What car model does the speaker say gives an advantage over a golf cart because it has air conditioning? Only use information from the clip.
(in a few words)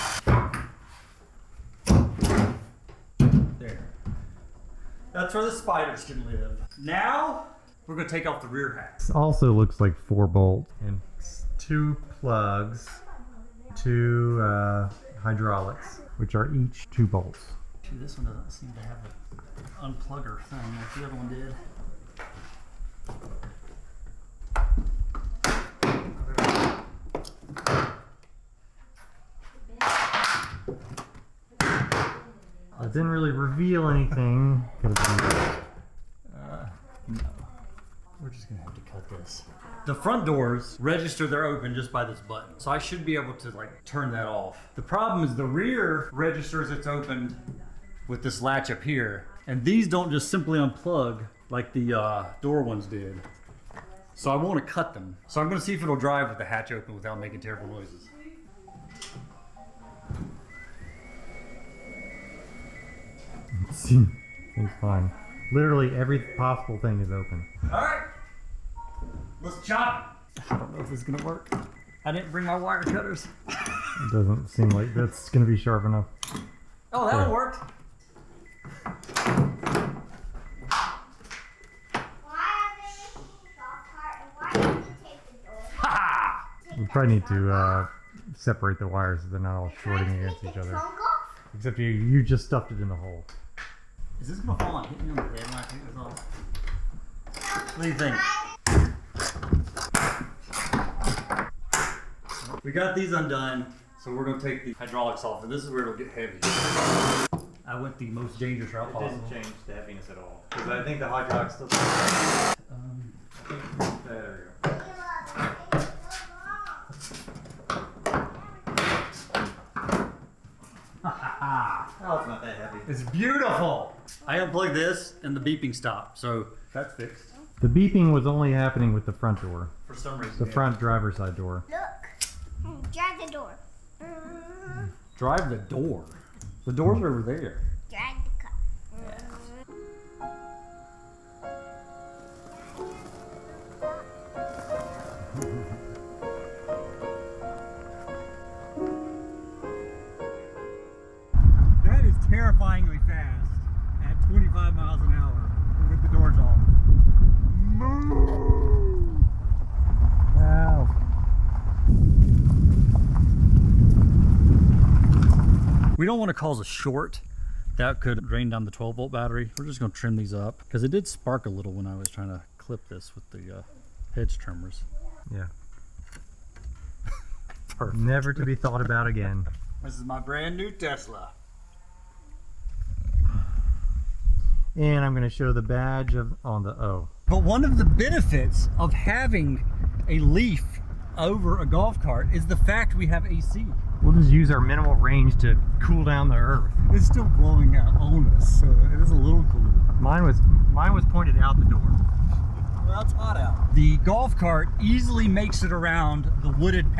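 Leaf.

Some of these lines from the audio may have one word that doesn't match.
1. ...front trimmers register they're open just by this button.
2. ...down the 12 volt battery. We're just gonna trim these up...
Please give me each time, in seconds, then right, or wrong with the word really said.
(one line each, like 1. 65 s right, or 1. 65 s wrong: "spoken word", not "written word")
1. 39 s wrong: "doors", not "trimmers"
2. 168 s right.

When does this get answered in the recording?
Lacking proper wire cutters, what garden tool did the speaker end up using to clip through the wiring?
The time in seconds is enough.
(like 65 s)
174 s.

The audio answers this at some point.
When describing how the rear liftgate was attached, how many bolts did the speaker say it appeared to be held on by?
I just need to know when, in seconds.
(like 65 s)
9 s.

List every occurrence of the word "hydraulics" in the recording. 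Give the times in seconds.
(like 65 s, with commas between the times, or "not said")
15 s, 104 s, 111 s.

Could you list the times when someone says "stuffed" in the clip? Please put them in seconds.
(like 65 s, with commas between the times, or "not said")
92 s.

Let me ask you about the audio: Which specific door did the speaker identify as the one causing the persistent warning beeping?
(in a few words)
front driver's side door.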